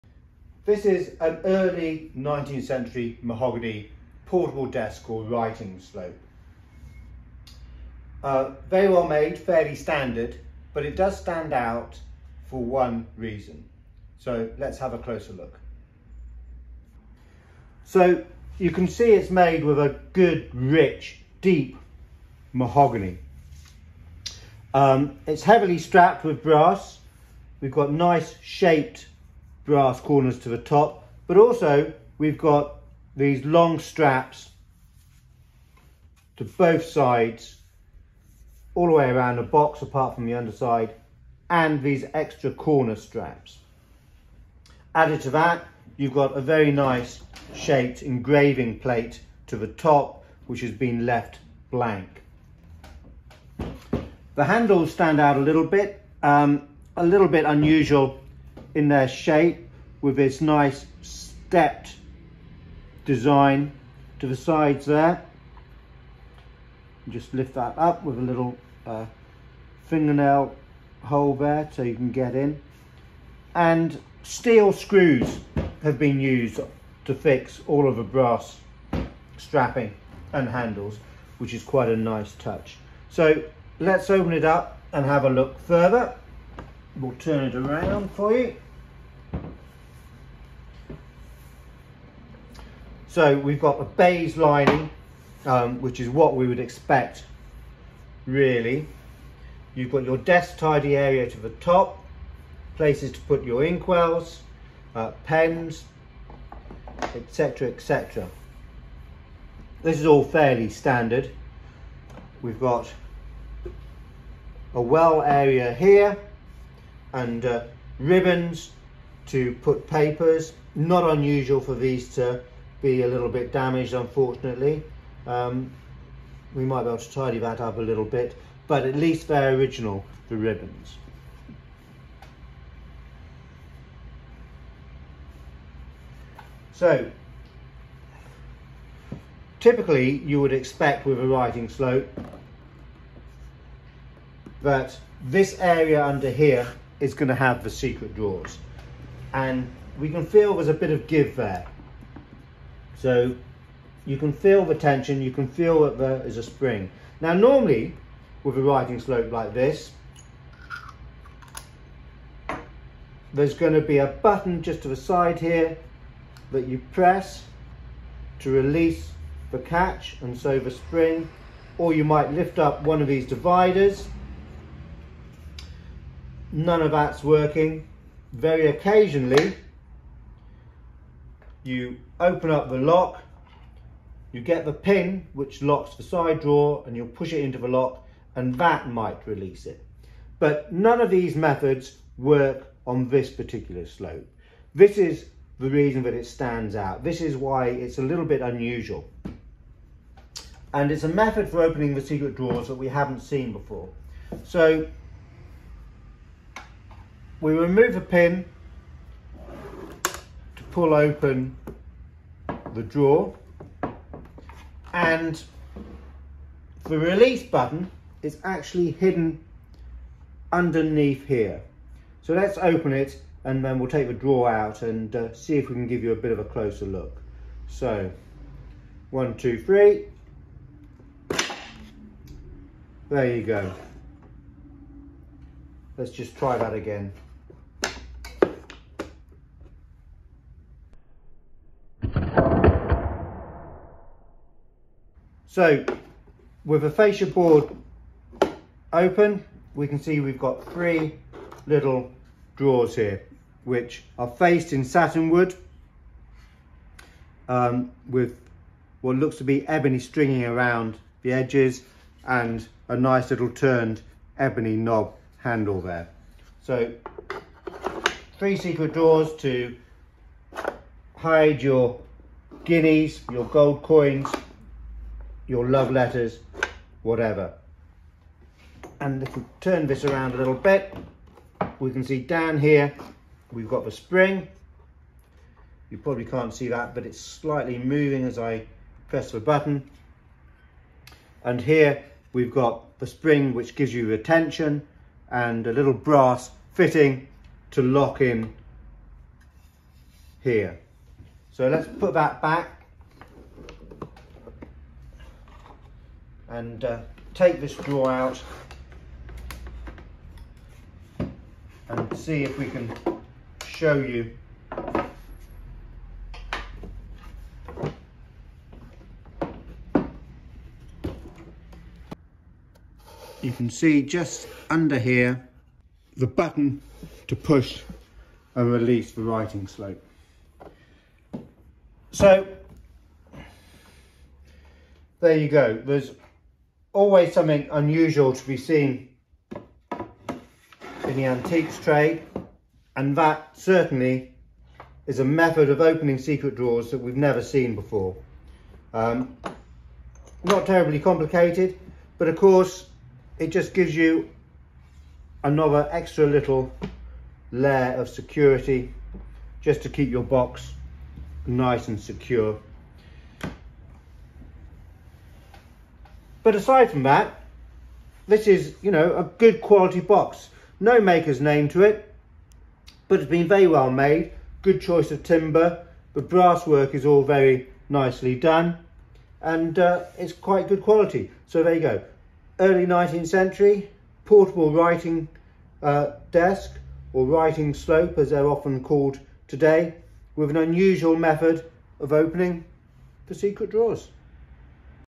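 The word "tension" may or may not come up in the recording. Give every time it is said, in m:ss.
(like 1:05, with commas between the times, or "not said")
2:34, 4:54.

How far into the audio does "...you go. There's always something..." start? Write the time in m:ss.
5:35.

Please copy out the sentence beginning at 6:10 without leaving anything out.
No maker's name to it, but it's been very well made.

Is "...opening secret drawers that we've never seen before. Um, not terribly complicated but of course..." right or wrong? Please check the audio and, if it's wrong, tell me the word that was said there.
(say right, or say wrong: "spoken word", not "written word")
right.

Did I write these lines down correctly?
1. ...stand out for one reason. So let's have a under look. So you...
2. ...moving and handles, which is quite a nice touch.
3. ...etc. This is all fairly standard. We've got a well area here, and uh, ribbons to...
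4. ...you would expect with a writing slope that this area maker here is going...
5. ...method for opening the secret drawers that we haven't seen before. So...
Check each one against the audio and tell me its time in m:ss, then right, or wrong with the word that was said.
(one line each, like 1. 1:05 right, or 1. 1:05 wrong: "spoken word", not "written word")
1. 0:11 wrong: "closer", not "under"
2. 1:19 wrong: "strapping", not "moving"
3. 1:47 right
4. 2:20 wrong: "under", not "maker"
5. 3:21 right.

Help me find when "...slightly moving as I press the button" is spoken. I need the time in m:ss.
4:47.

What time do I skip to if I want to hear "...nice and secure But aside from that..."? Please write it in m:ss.
6:01.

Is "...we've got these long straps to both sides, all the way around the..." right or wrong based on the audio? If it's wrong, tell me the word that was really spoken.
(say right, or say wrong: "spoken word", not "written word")
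right.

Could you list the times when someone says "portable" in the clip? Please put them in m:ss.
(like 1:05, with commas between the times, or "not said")
0:04, 6:24.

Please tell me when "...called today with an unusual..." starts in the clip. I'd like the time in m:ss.
6:28.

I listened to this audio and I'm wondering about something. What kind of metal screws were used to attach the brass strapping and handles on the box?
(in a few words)
Steel.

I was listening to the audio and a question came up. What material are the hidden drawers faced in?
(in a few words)
Satin.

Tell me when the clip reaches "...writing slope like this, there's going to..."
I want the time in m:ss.
2:38.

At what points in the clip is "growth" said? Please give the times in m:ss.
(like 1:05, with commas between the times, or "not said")
not said.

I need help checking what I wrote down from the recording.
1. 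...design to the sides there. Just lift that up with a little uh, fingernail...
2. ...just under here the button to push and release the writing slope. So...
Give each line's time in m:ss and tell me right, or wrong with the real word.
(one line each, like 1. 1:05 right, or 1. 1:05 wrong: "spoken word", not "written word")
1. 1:03 right
2. 5:24 right.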